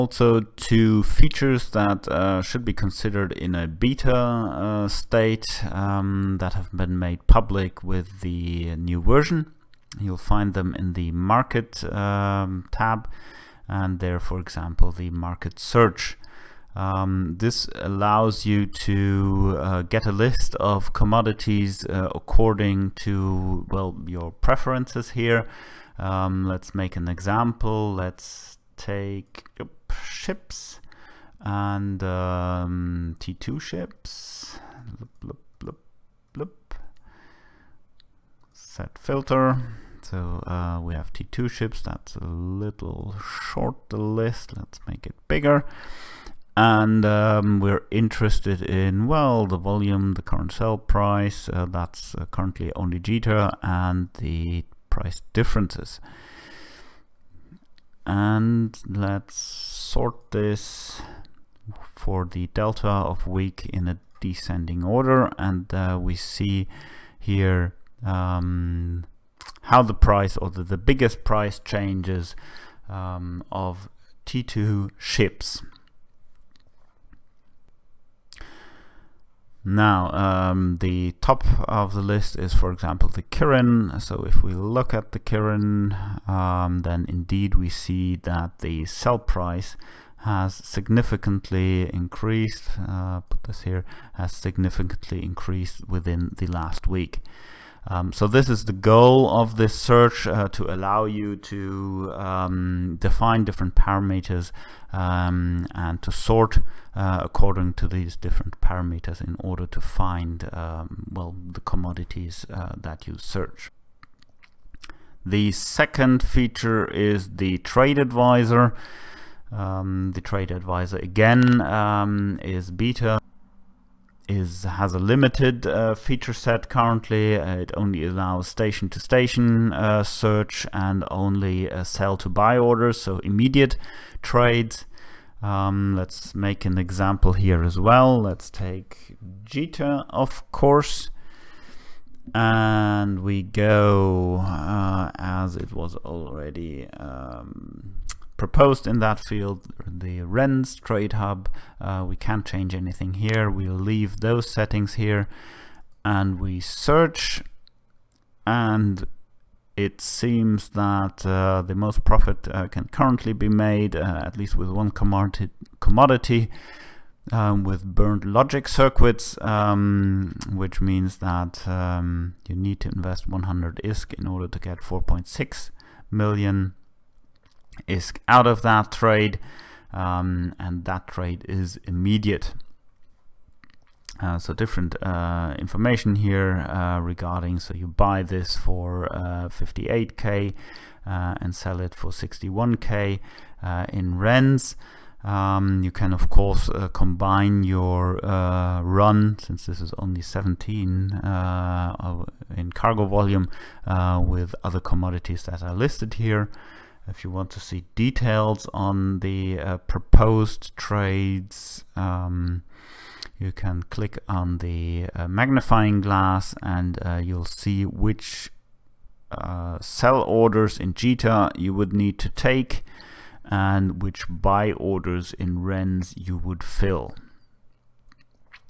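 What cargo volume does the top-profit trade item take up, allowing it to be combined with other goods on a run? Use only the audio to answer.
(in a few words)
17.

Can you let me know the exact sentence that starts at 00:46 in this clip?
And um, we're interested in, well, the volume, the current sale price, uh, that's uh, currently only Jita, and the price differences.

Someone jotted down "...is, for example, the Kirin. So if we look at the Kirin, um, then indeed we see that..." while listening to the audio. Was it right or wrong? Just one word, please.
right.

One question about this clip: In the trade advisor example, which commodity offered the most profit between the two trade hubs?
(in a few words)
Burned logic circuits.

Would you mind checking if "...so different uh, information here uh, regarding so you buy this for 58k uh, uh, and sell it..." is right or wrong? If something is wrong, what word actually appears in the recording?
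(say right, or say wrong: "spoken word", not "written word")
right.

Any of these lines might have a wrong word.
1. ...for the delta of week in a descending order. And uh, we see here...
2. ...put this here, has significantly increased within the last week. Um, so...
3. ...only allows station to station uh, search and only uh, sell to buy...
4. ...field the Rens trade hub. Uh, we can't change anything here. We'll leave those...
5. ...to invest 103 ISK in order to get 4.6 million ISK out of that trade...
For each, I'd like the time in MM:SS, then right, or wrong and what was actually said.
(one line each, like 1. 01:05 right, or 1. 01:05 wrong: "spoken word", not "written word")
1. 01:01 right
2. 01:33 right
3. 02:07 right
4. 02:29 right
5. 02:52 wrong: "100", not "103".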